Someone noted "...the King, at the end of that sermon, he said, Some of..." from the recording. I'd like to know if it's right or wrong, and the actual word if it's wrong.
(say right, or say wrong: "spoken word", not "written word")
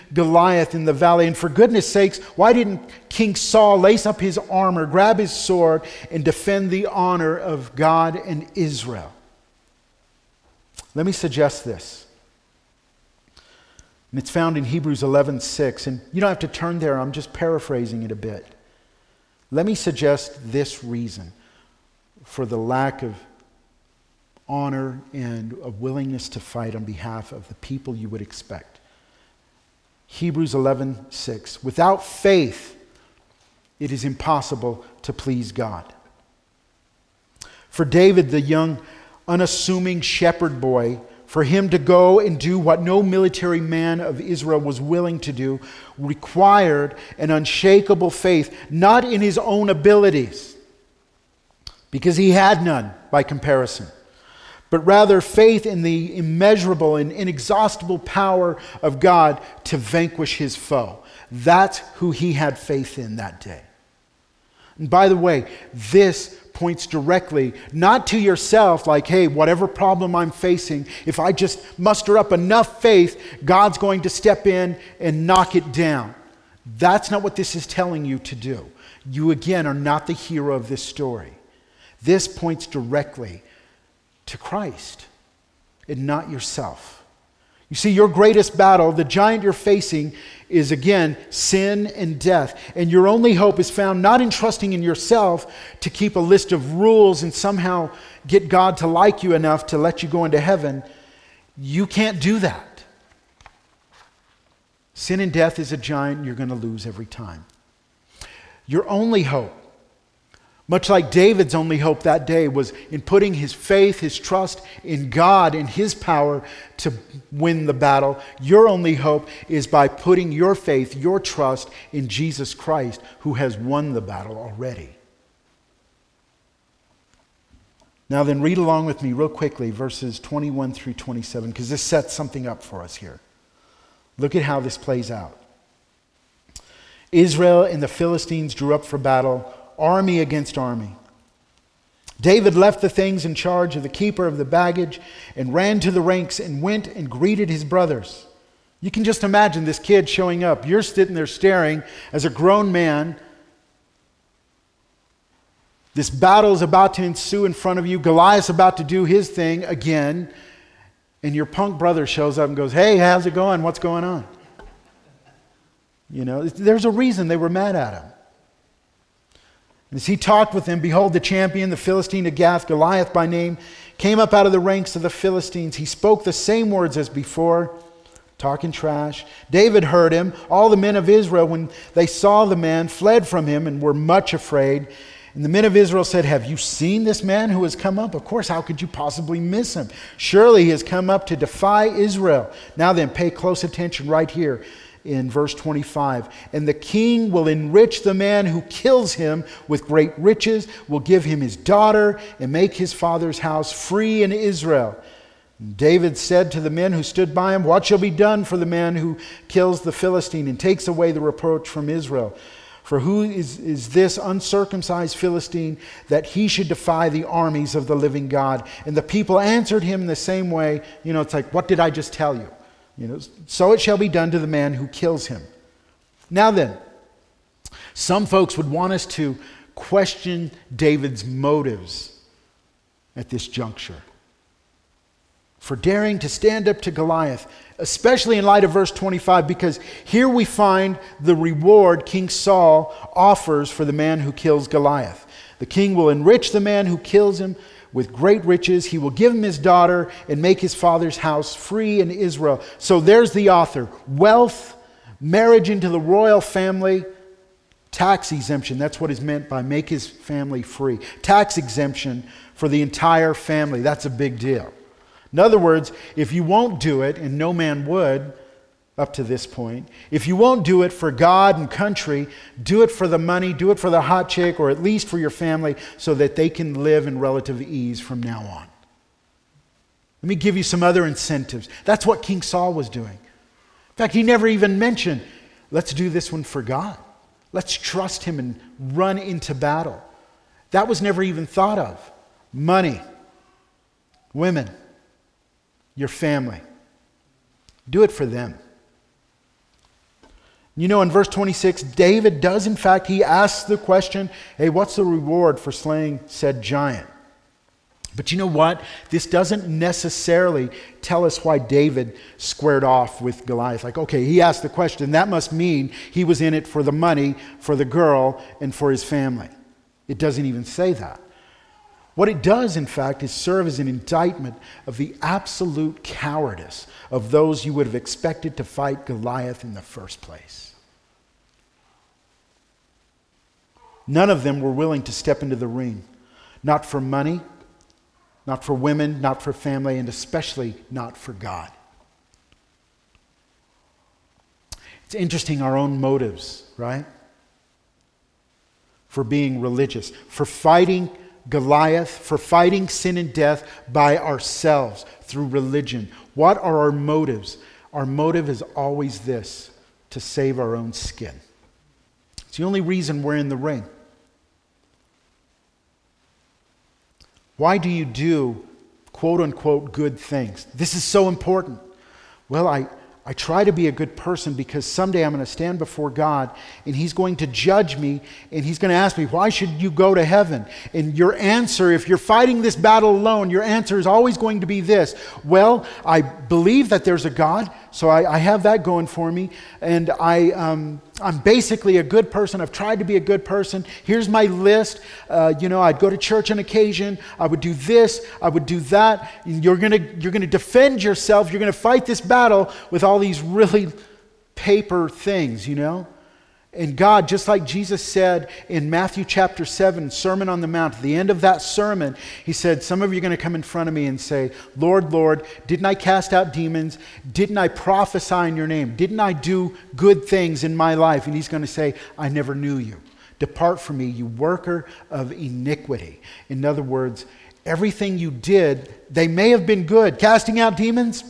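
wrong: "Mount", not "King".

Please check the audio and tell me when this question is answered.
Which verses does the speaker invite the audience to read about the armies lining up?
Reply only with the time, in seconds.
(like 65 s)
129 s.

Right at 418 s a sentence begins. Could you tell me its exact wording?
Didn't I do good things in my life?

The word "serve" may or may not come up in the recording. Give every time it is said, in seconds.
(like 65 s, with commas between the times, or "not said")
323 s.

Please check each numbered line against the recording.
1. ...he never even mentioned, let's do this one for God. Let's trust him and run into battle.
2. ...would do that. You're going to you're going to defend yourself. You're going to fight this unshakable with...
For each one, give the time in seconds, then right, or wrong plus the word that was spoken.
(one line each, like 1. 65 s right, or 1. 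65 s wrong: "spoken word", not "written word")
1. 284 s right
2. 398 s wrong: "battle", not "unshakable".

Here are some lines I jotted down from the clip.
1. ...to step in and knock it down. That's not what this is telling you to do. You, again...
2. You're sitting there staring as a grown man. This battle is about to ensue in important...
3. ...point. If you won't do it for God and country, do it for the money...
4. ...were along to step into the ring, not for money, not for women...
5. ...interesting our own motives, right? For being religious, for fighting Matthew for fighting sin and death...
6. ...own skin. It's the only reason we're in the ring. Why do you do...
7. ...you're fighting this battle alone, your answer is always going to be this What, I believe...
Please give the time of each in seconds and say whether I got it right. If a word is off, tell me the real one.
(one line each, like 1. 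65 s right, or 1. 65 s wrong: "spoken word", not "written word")
1. 74 s right
2. 150 s wrong: "front", not "important"
3. 269 s right
4. 334 s wrong: "willing", not "along"
5. 345 s wrong: "Goliath", not "Matthew"
6. 360 s right
7. 382 s wrong: "Well", not "What".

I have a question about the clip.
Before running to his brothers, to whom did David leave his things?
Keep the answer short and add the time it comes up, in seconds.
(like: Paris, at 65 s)
the keeper of the baggage, at 143 s.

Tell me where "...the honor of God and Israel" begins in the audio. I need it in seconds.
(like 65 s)
6 s.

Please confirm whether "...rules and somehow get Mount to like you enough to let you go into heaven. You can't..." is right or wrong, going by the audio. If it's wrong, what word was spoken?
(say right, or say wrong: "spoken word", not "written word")
wrong: "God", not "Mount".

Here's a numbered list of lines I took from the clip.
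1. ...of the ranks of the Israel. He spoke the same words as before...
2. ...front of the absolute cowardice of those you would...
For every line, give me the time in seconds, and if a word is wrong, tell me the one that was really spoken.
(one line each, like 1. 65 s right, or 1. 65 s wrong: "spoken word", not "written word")
1. 174 s wrong: "Philistines", not "Israel"
2. 323 s wrong: "indictment", not "front".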